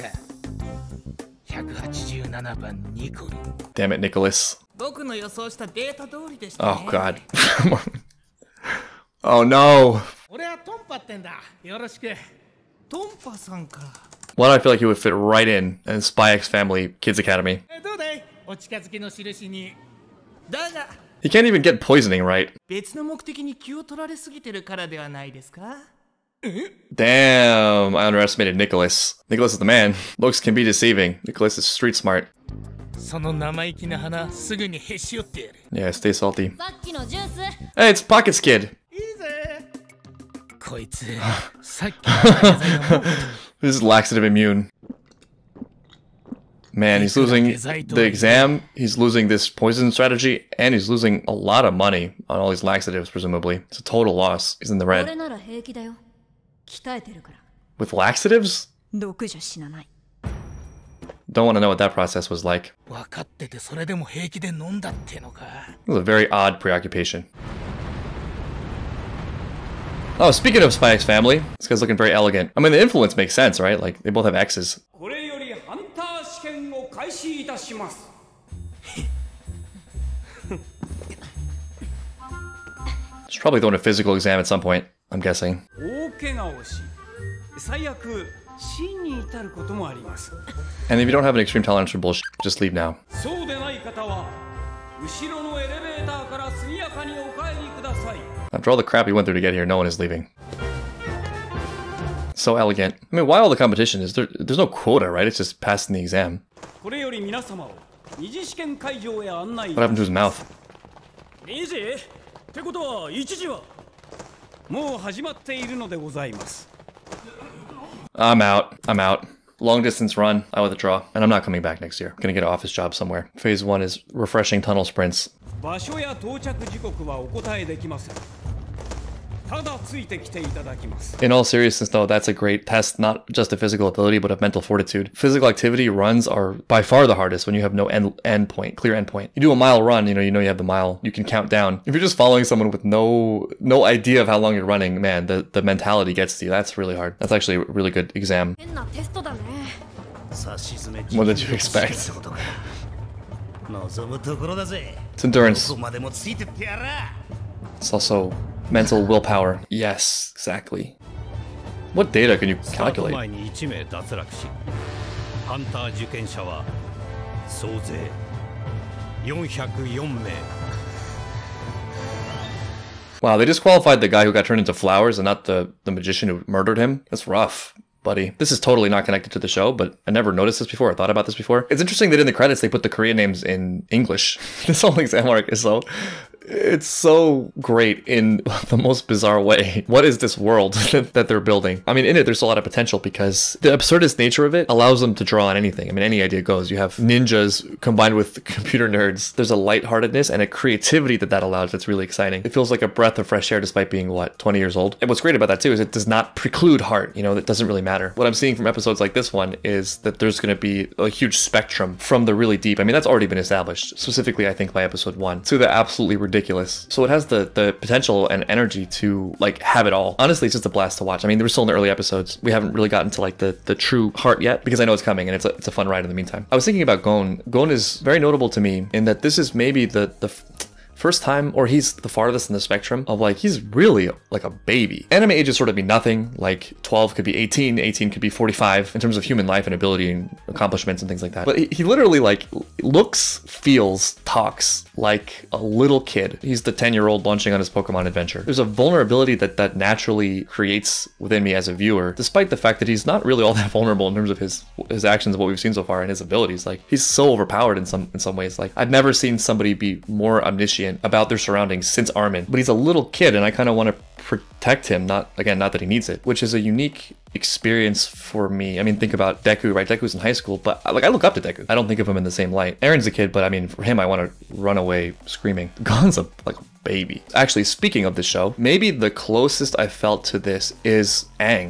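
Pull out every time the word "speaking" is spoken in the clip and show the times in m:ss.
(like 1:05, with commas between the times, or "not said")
1:10, 4:37.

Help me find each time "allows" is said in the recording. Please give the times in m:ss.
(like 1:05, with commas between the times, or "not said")
3:14, 3:21.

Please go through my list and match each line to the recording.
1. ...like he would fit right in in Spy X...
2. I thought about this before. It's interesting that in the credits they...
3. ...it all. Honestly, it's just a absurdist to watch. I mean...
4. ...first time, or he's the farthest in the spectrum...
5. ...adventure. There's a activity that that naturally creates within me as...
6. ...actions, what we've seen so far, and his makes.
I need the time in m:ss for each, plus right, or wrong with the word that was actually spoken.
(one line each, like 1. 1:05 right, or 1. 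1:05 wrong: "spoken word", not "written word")
1. 0:14 right
2. 3:00 right
3. 3:39 wrong: "blast", not "absurdist"
4. 3:51 right
5. 4:08 wrong: "vulnerability", not "activity"
6. 4:15 wrong: "abilities", not "makes".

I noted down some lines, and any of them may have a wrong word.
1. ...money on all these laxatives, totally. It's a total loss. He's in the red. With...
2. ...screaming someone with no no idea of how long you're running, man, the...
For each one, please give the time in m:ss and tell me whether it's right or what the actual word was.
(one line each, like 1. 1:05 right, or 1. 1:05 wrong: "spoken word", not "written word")
1. 0:51 wrong: "presumably", not "totally"
2. 2:22 wrong: "following", not "screaming".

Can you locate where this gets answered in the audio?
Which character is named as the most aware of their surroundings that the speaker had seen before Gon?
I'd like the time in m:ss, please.
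4:22.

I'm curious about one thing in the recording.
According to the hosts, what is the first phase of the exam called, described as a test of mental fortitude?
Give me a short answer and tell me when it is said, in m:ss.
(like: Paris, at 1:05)
Tunnel sprints, at 2:04.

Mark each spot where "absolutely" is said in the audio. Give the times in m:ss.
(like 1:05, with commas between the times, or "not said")
3:35.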